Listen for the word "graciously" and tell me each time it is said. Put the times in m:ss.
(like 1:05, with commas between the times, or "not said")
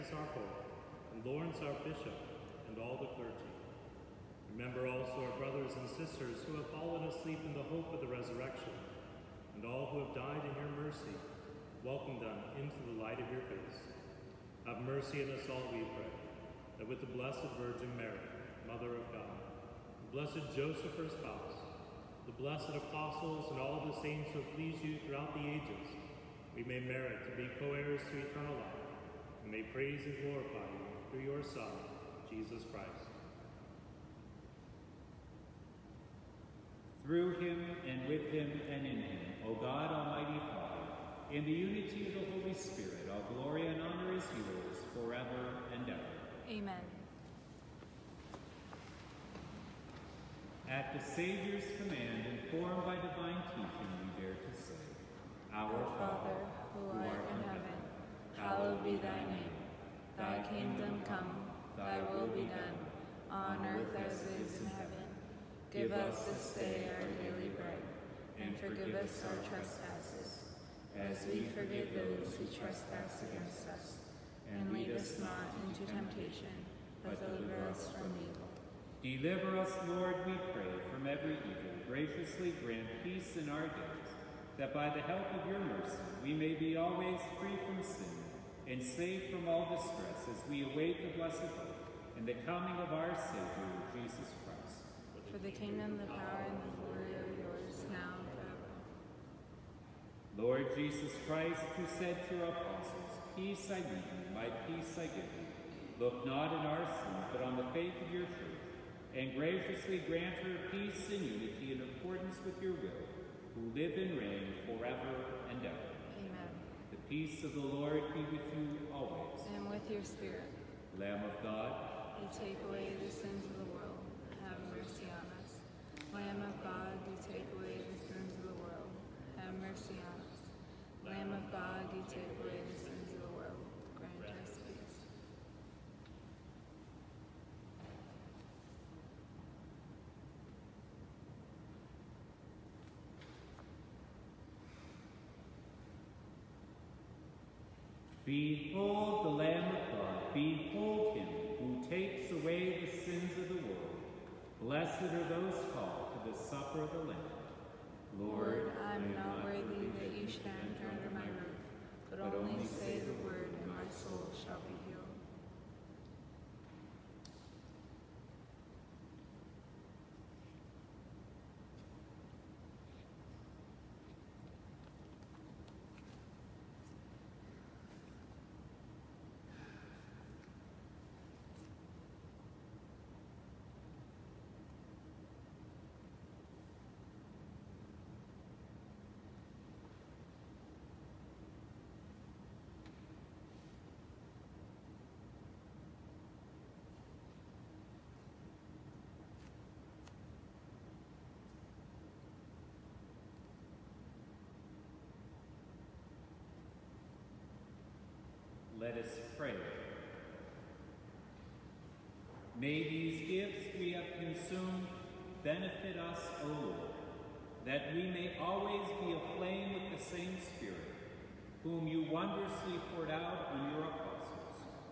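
1:21, 1:49.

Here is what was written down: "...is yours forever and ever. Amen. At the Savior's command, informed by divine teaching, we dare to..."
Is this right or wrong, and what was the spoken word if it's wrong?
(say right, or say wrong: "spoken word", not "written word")
right.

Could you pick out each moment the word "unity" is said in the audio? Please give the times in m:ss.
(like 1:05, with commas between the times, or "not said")
0:41, 1:51.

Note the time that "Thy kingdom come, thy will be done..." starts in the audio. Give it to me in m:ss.
1:00.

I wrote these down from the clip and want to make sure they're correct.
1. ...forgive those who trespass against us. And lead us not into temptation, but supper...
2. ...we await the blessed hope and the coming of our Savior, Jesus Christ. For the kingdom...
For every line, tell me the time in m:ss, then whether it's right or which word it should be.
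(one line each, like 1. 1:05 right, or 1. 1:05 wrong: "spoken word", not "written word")
1. 1:11 wrong: "deliver", not "supper"
2. 1:30 right.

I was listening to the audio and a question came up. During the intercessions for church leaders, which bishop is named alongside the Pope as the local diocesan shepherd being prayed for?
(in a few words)
Lawrence.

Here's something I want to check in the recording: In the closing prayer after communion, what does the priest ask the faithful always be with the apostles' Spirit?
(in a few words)
aflame.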